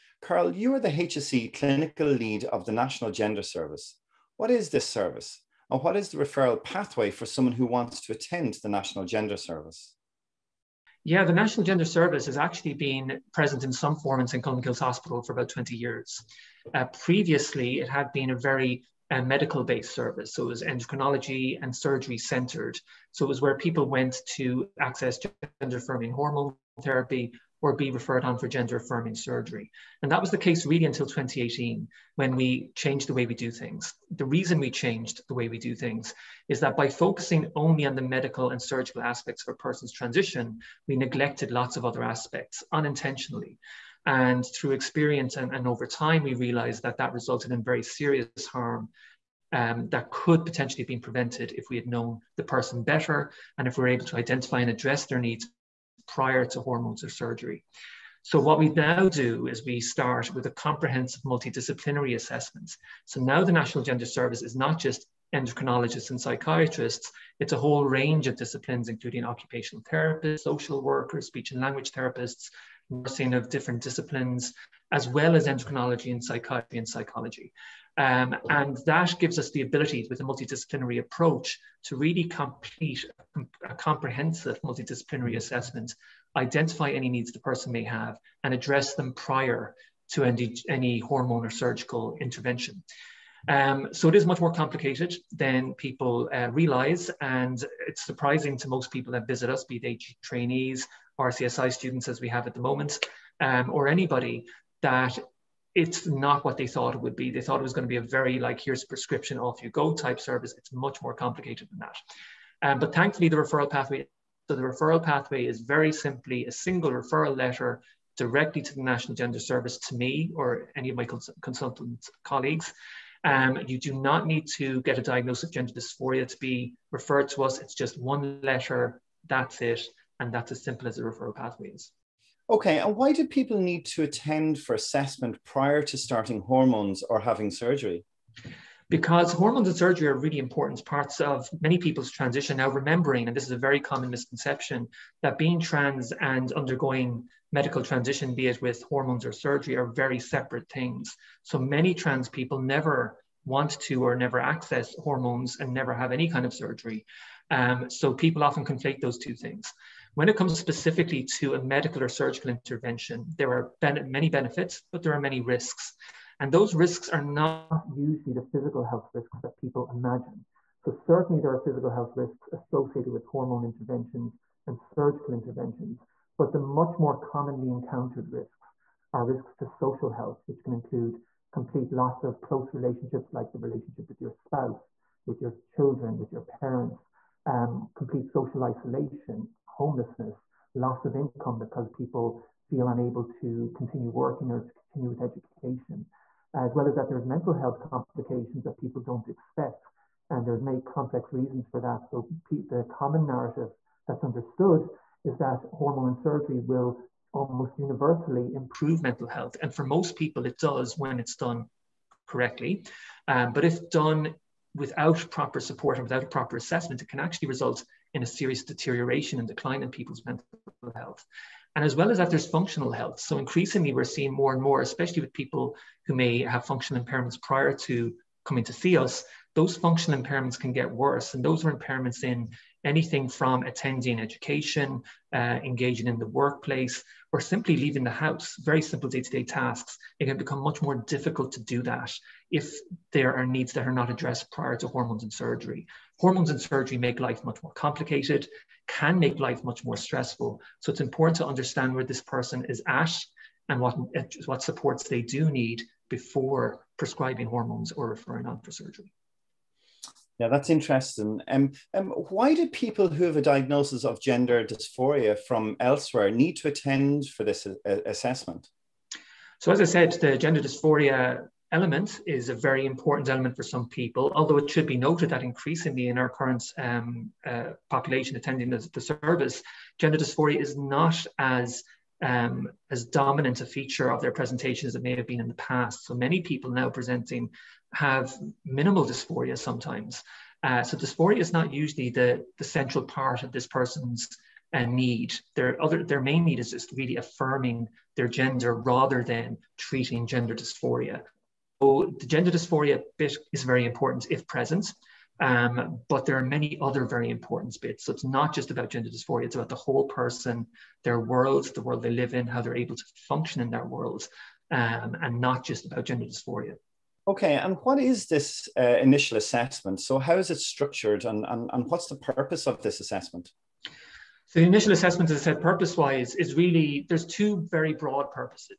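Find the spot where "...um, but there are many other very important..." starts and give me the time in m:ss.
5:05.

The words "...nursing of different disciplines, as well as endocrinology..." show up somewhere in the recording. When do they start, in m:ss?
1:12.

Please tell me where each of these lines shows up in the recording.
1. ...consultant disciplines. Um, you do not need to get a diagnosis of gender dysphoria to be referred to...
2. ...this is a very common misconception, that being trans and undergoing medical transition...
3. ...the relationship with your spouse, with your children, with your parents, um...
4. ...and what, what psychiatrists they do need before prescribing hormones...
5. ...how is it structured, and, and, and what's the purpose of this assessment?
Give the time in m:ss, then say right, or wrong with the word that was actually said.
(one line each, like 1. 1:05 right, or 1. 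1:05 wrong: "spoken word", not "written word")
1. 2:01 wrong: "colleagues", not "disciplines"
2. 2:23 right
3. 3:03 right
4. 4:13 wrong: "supports", not "psychiatrists"
5. 5:20 right.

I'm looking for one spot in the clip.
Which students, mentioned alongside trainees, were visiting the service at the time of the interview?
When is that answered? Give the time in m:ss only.
1:41.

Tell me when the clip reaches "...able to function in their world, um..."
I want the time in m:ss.
5:12.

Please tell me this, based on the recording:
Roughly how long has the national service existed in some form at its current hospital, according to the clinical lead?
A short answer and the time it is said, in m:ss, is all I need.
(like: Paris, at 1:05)
About 20 years, at 0:15.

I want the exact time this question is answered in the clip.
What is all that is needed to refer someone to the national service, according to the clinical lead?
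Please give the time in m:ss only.
1:56.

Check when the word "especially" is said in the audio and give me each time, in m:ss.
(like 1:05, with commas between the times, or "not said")
3:44.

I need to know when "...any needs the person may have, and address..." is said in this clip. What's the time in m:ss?
1:26.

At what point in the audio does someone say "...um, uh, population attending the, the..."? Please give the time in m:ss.
4:36.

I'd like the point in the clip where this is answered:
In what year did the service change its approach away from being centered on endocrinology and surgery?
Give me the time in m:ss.
0:31.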